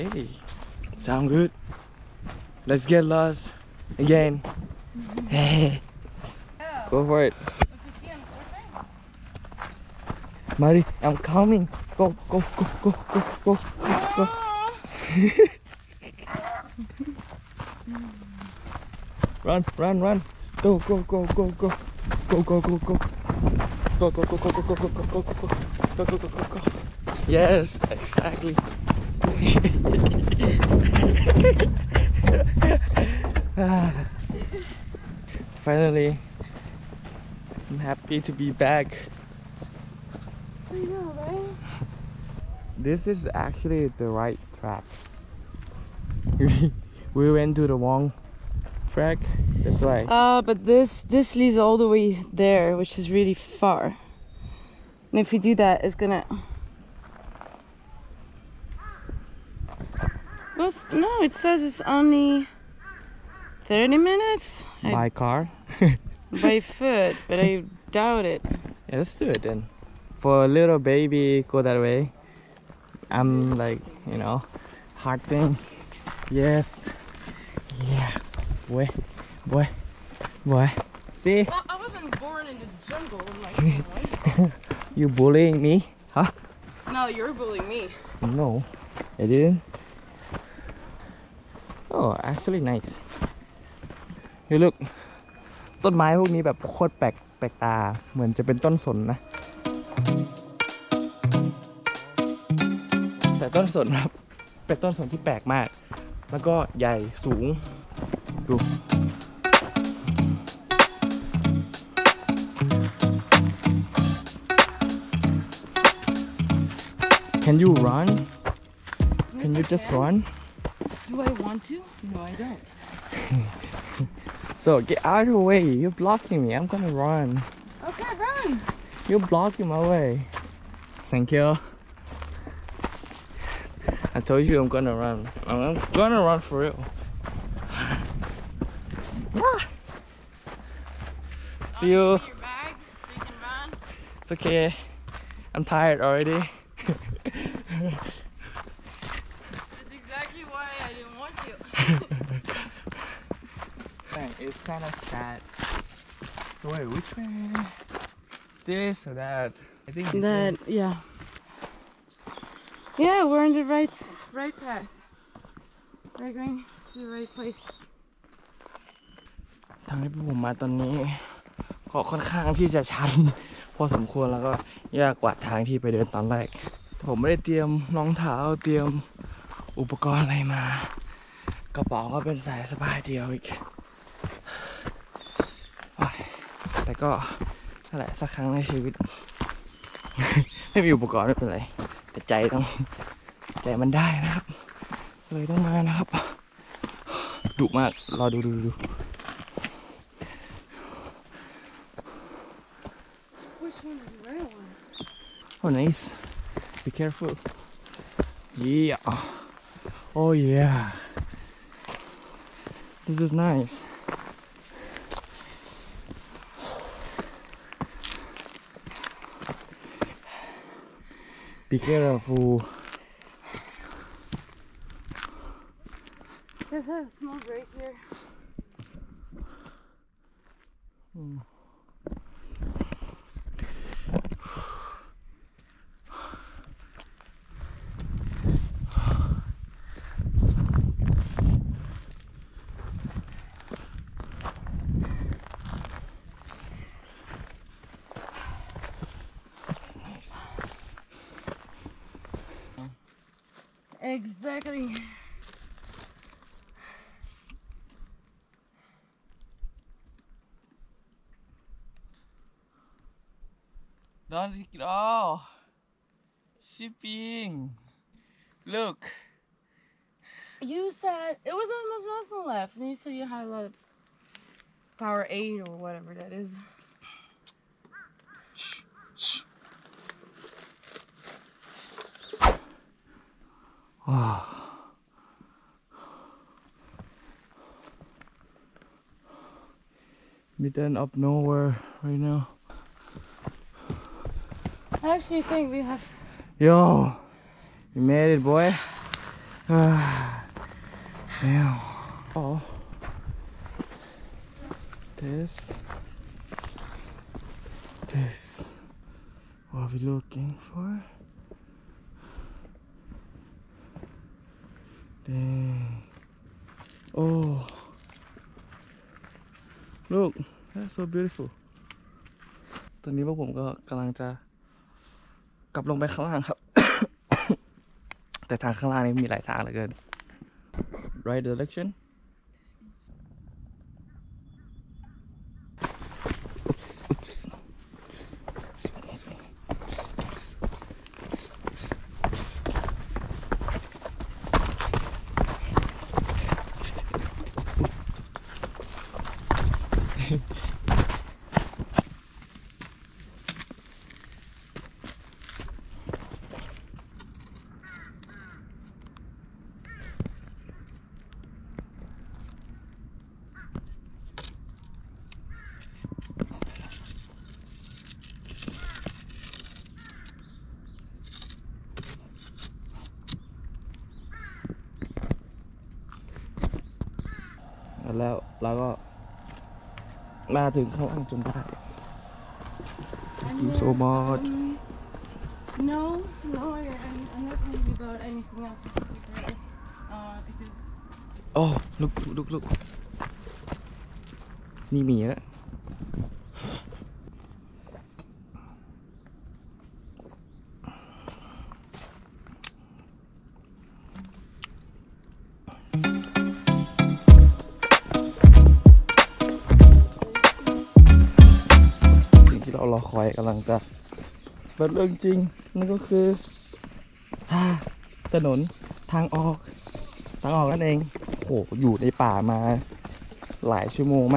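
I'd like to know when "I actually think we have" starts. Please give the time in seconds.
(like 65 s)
295 s.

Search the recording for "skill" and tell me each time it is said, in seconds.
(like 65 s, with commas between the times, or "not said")
not said.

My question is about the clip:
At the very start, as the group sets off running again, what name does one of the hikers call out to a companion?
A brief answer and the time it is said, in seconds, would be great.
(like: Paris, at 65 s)
Marie, at 10 s.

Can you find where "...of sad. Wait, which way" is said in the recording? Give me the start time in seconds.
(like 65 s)
154 s.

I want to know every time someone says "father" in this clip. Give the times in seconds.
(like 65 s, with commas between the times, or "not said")
not said.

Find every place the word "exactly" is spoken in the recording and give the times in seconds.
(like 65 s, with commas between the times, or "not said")
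27 s, 149 s, 254 s.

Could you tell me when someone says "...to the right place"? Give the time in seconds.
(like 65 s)
166 s.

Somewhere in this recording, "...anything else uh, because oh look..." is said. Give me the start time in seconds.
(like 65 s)
388 s.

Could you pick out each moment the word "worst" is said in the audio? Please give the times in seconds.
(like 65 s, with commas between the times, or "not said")
not said.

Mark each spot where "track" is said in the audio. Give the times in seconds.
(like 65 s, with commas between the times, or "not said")
44 s, 48 s.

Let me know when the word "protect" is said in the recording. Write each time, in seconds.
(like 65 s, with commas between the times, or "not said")
not said.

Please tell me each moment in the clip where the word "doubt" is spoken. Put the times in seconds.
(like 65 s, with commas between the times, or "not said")
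67 s.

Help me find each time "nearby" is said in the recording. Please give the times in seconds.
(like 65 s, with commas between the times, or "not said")
not said.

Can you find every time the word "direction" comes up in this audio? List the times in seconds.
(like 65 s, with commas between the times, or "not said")
331 s.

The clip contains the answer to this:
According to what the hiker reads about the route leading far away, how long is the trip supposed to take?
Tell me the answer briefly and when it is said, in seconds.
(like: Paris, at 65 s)
30 minutes, at 63 s.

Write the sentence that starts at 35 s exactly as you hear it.
Finally, I'm happy to be back.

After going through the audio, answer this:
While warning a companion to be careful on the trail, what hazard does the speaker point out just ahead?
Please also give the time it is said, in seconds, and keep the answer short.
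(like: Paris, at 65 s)
A small break, at 227 s.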